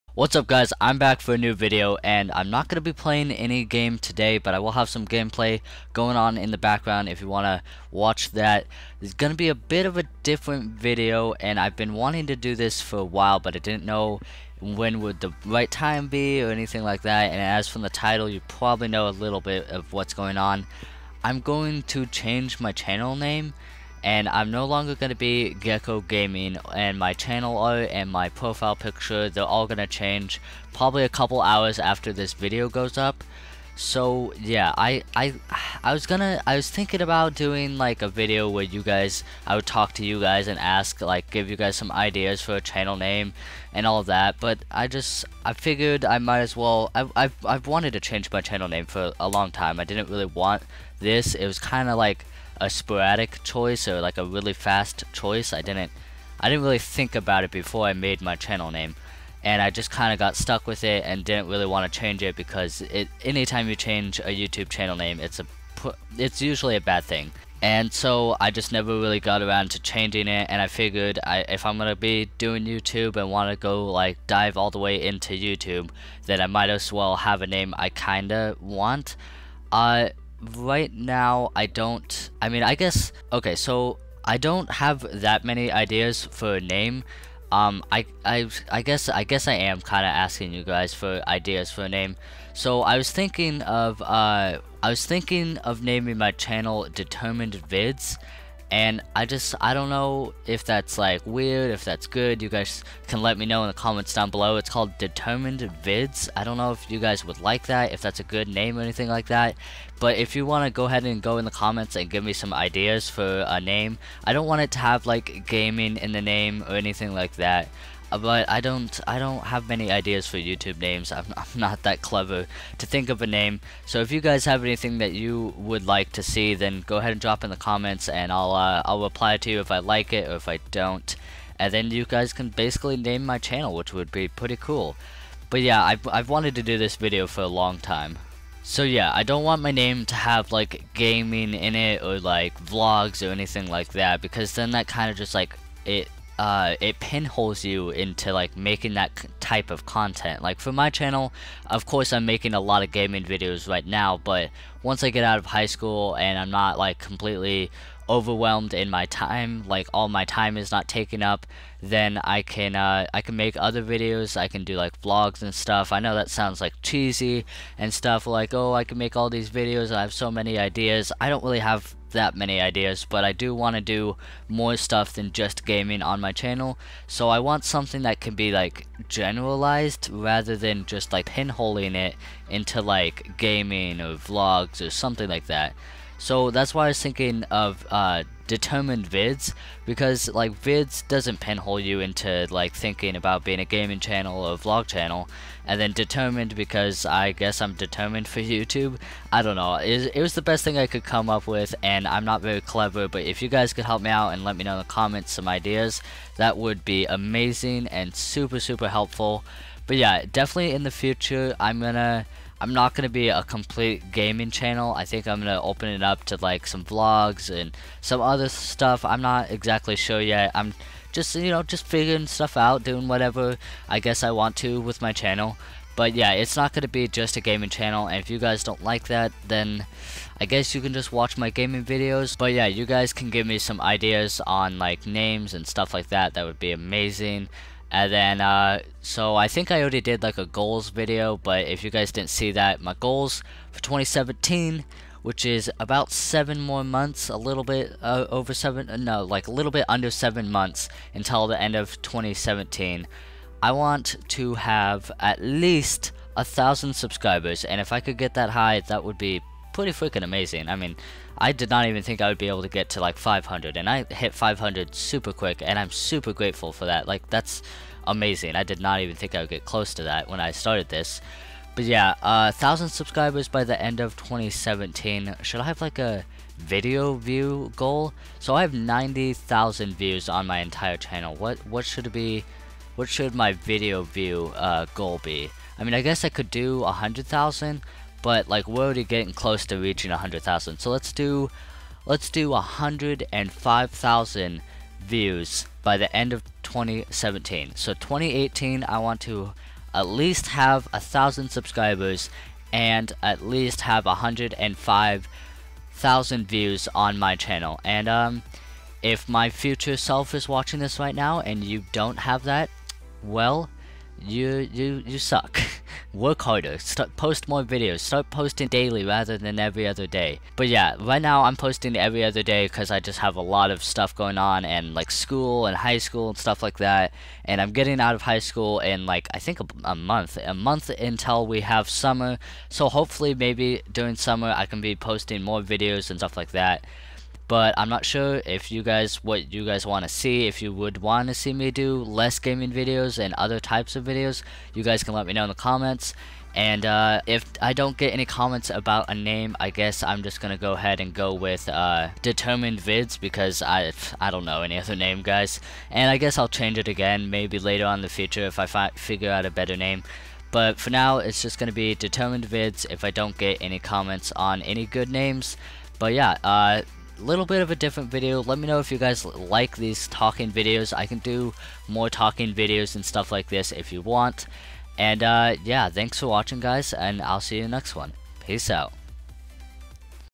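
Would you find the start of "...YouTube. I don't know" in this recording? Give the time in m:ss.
3:18.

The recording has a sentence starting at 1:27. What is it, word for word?
Um, I, I, I guess, I guess I am kind of asking you guys for ideas for a name.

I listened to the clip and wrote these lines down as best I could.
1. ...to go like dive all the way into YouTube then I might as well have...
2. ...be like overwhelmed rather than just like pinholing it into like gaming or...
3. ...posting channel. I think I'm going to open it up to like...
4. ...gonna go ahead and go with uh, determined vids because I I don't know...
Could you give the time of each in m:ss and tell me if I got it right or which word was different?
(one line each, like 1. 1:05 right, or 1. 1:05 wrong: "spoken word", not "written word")
1. 1:13 right
2. 2:58 wrong: "generalized", not "overwhelmed"
3. 3:34 wrong: "gaming", not "posting"
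4. 5:50 right.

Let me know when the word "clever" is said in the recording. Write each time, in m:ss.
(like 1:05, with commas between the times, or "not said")
2:02, 3:22.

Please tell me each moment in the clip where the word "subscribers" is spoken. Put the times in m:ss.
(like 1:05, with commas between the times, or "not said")
4:16, 4:32, 5:01.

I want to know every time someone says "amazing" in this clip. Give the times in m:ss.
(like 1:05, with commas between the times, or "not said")
3:27, 3:56, 4:20, 4:28.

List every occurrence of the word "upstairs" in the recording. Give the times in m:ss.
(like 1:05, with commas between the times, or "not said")
not said.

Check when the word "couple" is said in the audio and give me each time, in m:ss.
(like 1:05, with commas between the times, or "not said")
0:31.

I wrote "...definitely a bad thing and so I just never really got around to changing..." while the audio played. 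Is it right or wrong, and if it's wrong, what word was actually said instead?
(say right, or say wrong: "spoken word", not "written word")
wrong: "usually", not "definitely".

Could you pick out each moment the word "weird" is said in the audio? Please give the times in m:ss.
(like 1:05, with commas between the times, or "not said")
1:41.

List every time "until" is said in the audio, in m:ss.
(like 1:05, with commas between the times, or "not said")
4:11, 5:30.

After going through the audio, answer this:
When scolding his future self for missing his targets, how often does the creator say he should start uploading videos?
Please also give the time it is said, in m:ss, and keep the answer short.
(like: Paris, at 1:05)
Daily, at 5:18.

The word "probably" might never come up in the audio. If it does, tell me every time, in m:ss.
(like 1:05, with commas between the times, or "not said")
0:18, 0:30.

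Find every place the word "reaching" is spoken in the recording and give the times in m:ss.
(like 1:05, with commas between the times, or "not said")
4:49.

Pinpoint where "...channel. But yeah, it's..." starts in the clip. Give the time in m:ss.
3:45.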